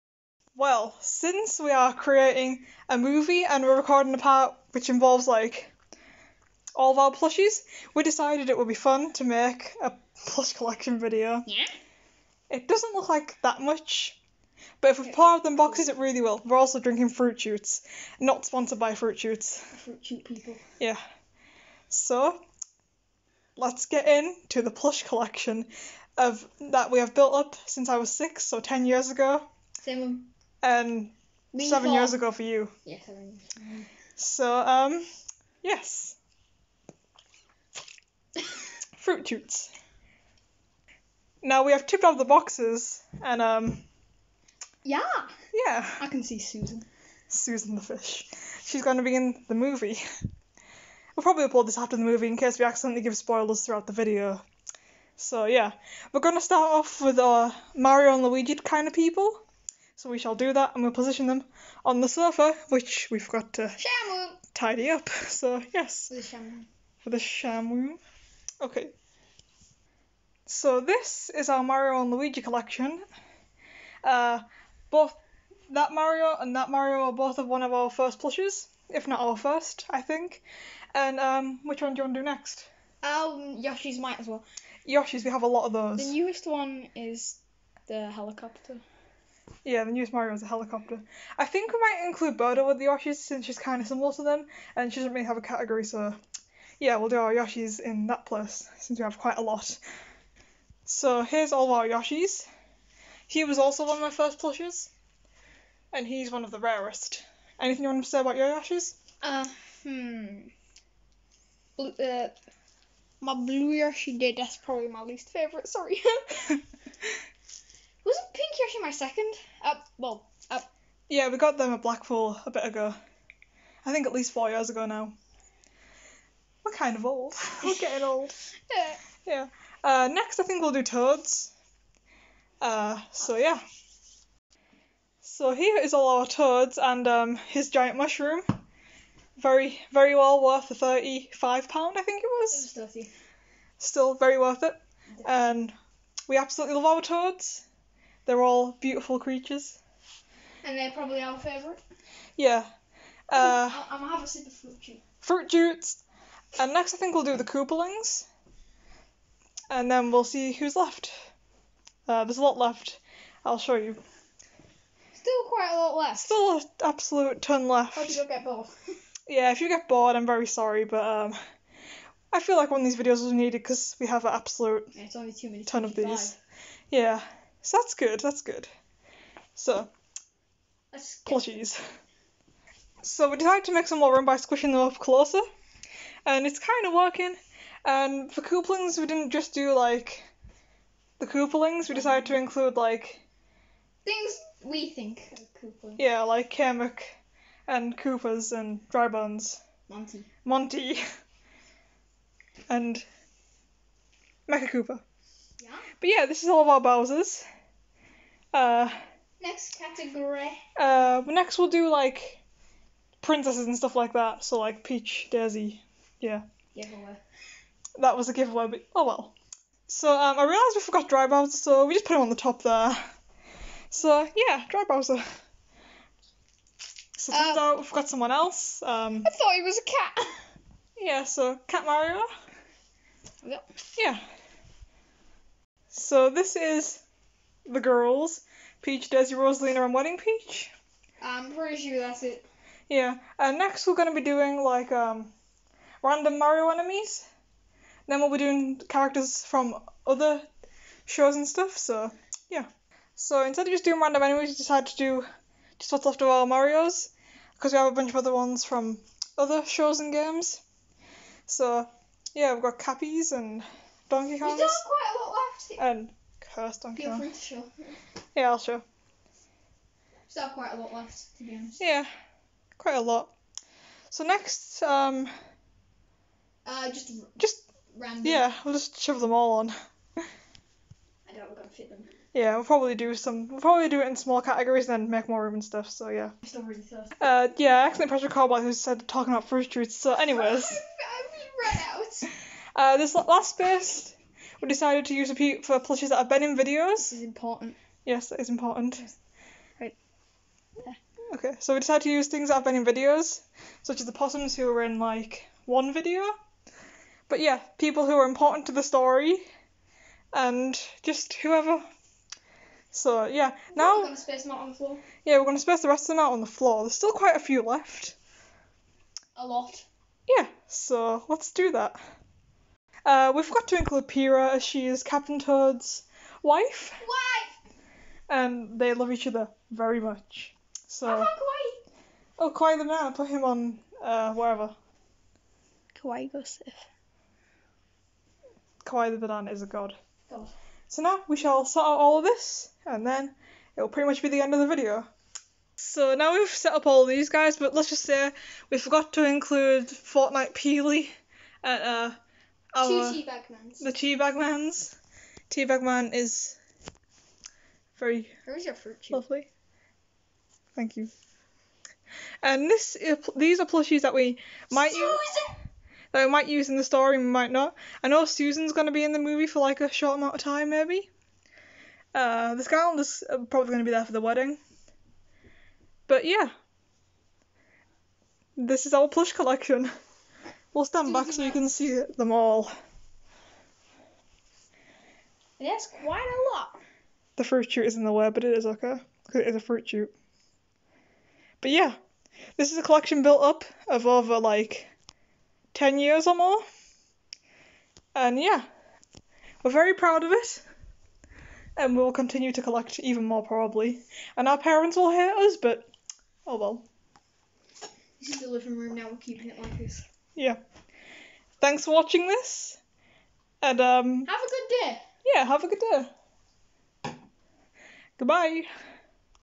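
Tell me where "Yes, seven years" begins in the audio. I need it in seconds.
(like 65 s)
32 s.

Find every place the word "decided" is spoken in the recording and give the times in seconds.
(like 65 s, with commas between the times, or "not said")
8 s, 183 s, 191 s, 254 s, 294 s, 301 s.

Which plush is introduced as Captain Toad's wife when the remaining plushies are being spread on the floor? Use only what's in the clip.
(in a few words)
Pira.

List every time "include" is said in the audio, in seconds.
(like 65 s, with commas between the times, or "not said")
92 s, 192 s, 323 s, 349 s.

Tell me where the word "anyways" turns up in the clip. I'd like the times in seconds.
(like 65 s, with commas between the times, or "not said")
290 s.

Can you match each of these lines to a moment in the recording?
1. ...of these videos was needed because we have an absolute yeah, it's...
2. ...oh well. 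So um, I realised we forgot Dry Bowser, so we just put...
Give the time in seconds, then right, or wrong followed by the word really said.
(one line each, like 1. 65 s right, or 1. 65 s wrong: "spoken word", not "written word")
1. 172 s right
2. 218 s right.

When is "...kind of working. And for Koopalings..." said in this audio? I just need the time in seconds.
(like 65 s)
186 s.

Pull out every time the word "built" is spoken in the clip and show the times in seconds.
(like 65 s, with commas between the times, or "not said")
27 s, 393 s.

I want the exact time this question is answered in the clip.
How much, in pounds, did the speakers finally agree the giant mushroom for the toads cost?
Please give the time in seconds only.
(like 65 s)
142 s.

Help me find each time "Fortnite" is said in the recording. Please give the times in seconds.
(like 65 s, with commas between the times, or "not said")
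349 s.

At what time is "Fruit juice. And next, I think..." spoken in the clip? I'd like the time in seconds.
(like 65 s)
155 s.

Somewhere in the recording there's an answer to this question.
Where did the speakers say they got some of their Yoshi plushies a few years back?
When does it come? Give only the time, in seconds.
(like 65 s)
121 s.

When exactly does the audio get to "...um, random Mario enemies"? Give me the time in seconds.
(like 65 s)
244 s.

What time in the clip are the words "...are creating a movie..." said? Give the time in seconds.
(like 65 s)
1 s.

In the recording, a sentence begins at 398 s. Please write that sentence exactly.
And yeah, we're very proud of it.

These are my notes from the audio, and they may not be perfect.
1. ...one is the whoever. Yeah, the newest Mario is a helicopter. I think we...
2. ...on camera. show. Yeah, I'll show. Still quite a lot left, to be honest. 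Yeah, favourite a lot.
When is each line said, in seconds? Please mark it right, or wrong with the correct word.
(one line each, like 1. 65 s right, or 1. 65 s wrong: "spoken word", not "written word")
1. 86 s wrong: "helicopter", not "whoever"
2. 266 s wrong: "quite", not "favourite".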